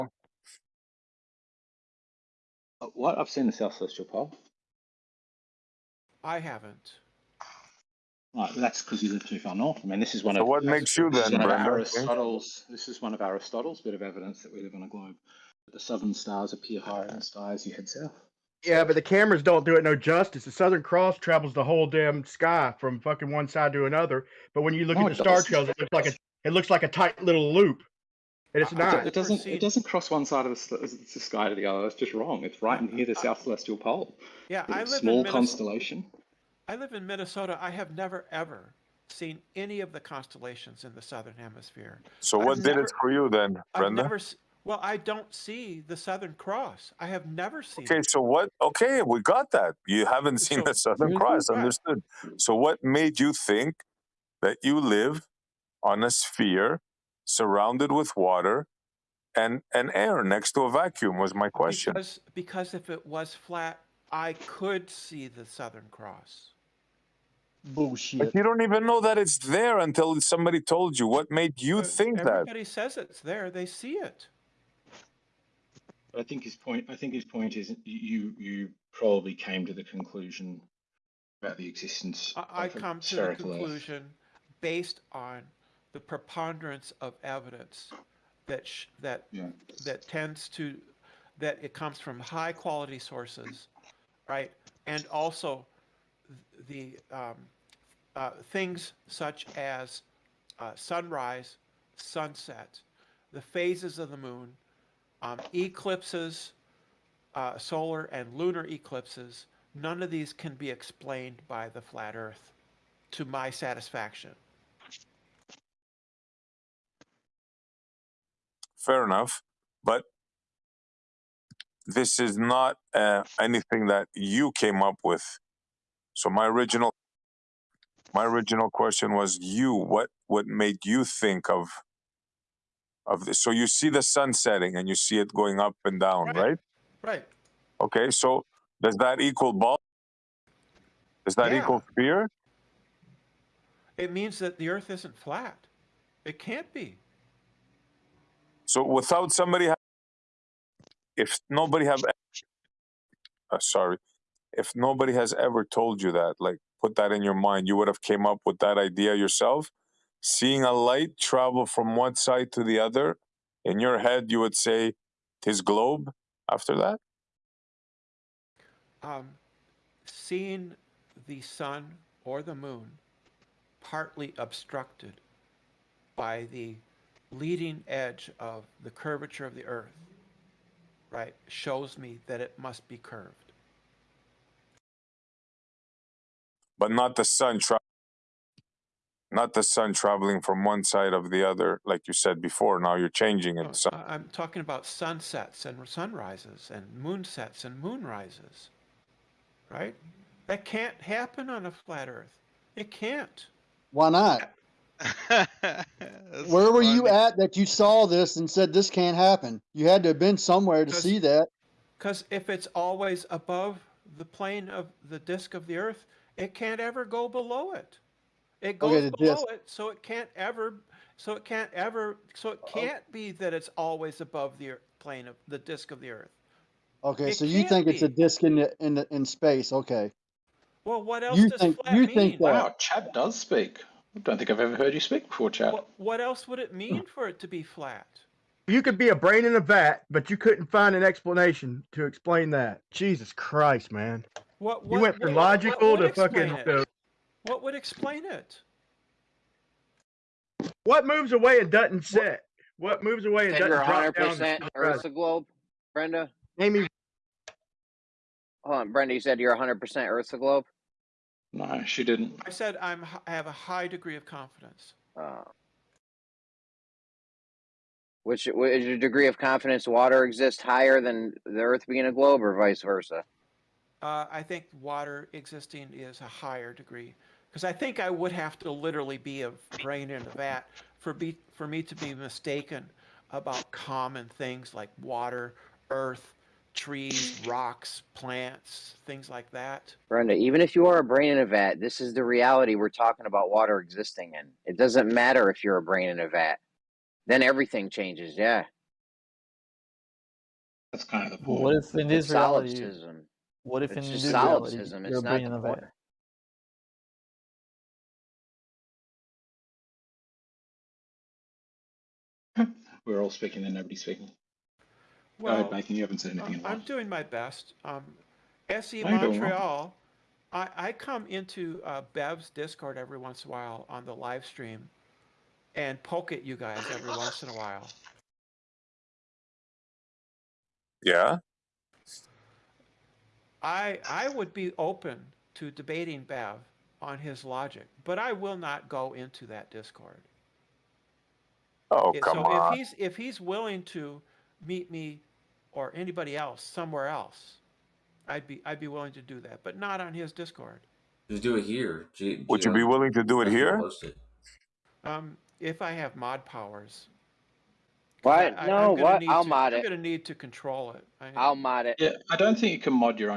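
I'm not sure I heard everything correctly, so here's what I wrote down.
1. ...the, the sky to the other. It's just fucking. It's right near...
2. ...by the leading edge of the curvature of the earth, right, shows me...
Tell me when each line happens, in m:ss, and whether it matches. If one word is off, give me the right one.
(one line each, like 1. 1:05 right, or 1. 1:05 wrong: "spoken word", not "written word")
1. 0:30 wrong: "wrong", not "fucking"
2. 2:56 right.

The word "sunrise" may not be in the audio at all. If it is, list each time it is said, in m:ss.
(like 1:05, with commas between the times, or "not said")
1:40, 3:15.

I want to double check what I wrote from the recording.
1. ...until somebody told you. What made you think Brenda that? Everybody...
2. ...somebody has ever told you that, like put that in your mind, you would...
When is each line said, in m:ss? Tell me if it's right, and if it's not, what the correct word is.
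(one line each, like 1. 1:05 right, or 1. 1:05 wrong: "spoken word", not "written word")
1. 1:09 wrong: "Everybody", not "Brenda"
2. 2:34 wrong: "nobody", not "somebody".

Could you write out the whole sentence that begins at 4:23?
I have a high degree of confidence.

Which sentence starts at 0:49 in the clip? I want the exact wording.
You haven't seen so, the Southern Cross.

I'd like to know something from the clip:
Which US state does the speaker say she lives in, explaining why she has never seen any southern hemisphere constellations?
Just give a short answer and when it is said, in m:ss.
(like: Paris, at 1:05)
Minnesota, at 0:37.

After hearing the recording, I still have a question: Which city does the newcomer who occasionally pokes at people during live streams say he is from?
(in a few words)
Montreal.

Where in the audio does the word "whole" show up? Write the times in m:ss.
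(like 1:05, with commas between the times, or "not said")
0:21.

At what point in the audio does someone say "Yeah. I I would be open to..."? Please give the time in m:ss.
5:31.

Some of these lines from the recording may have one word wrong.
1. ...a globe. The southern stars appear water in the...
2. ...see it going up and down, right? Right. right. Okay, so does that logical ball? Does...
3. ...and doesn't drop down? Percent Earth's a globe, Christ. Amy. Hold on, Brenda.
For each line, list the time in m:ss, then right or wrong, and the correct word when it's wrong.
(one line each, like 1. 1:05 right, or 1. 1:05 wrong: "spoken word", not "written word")
1. 0:14 wrong: "higher", not "water"
2. 2:14 wrong: "equal", not "logical"
3. 4:13 wrong: "Brenda", not "Christ".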